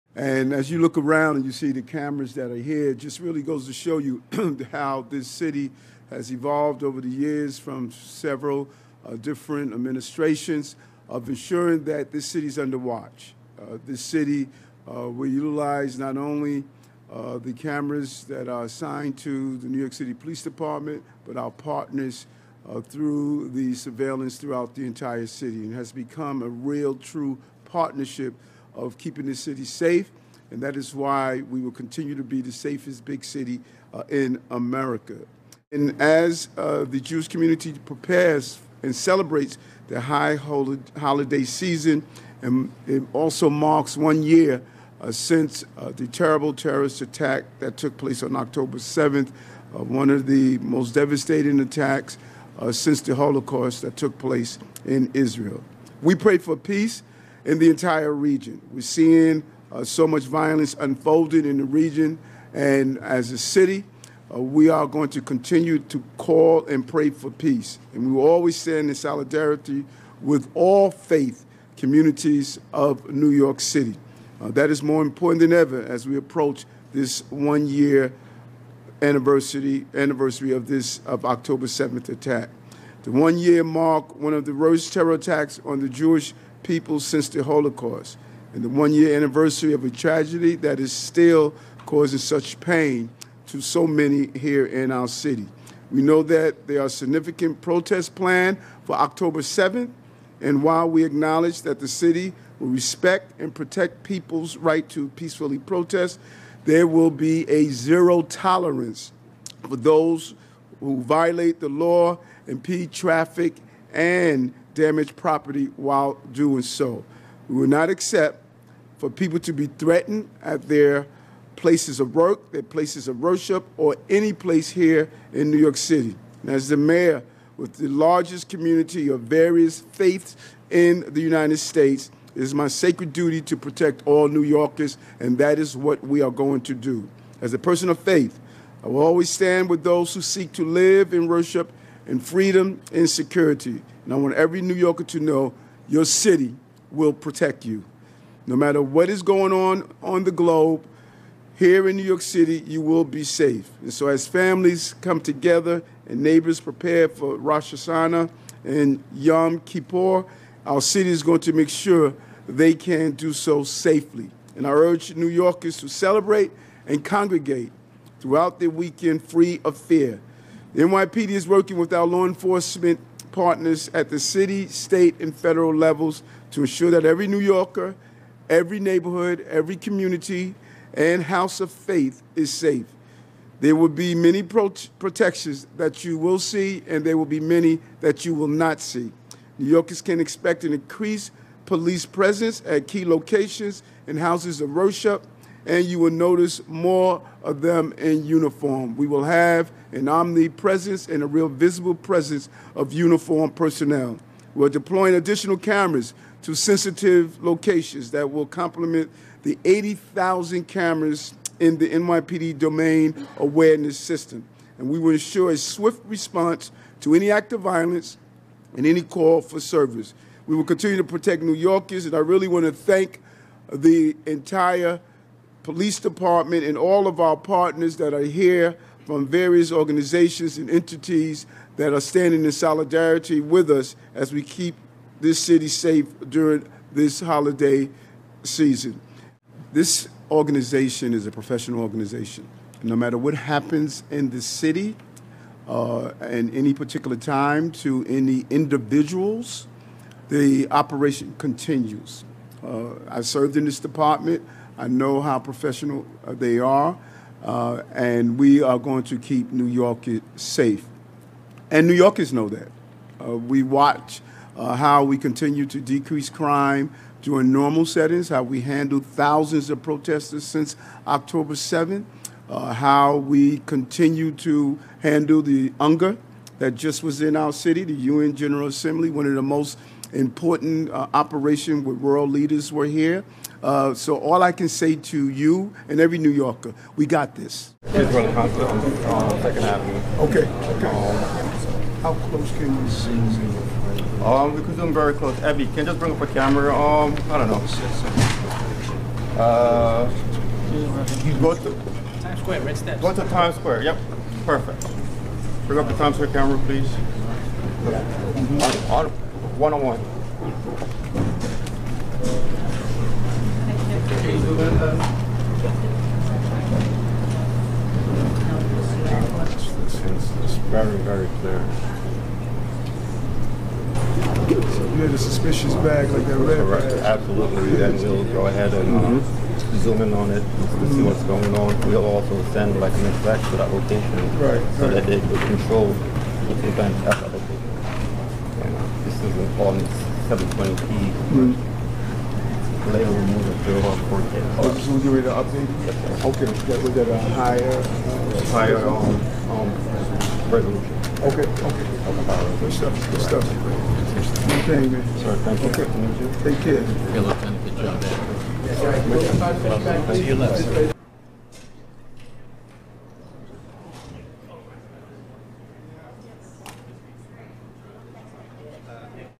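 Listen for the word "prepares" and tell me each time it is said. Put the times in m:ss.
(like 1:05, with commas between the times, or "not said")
0:37, 2:36.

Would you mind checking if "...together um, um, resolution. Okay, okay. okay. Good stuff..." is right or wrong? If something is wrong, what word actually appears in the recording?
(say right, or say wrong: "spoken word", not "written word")
wrong: "higher", not "together".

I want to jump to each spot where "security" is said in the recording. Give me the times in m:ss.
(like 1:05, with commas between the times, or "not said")
2:23.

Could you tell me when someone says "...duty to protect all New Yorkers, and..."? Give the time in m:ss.
2:13.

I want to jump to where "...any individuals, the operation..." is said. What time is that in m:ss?
4:08.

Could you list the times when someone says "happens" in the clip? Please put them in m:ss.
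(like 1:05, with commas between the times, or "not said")
4:03.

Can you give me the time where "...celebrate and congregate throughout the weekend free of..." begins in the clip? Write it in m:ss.
2:45.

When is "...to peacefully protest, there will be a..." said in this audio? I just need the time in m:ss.
1:44.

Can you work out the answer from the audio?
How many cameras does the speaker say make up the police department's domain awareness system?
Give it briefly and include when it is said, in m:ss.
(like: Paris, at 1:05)
80,000, at 3:29.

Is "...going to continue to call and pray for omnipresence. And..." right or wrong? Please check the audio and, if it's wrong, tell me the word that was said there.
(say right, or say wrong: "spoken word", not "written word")
wrong: "peace", not "omnipresence".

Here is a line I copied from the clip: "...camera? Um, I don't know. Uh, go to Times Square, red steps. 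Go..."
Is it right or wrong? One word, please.
right.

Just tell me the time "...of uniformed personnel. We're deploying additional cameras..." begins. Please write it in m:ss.
3:22.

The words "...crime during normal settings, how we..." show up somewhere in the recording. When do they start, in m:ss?
4:26.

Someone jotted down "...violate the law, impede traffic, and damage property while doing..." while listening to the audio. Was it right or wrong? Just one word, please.
right.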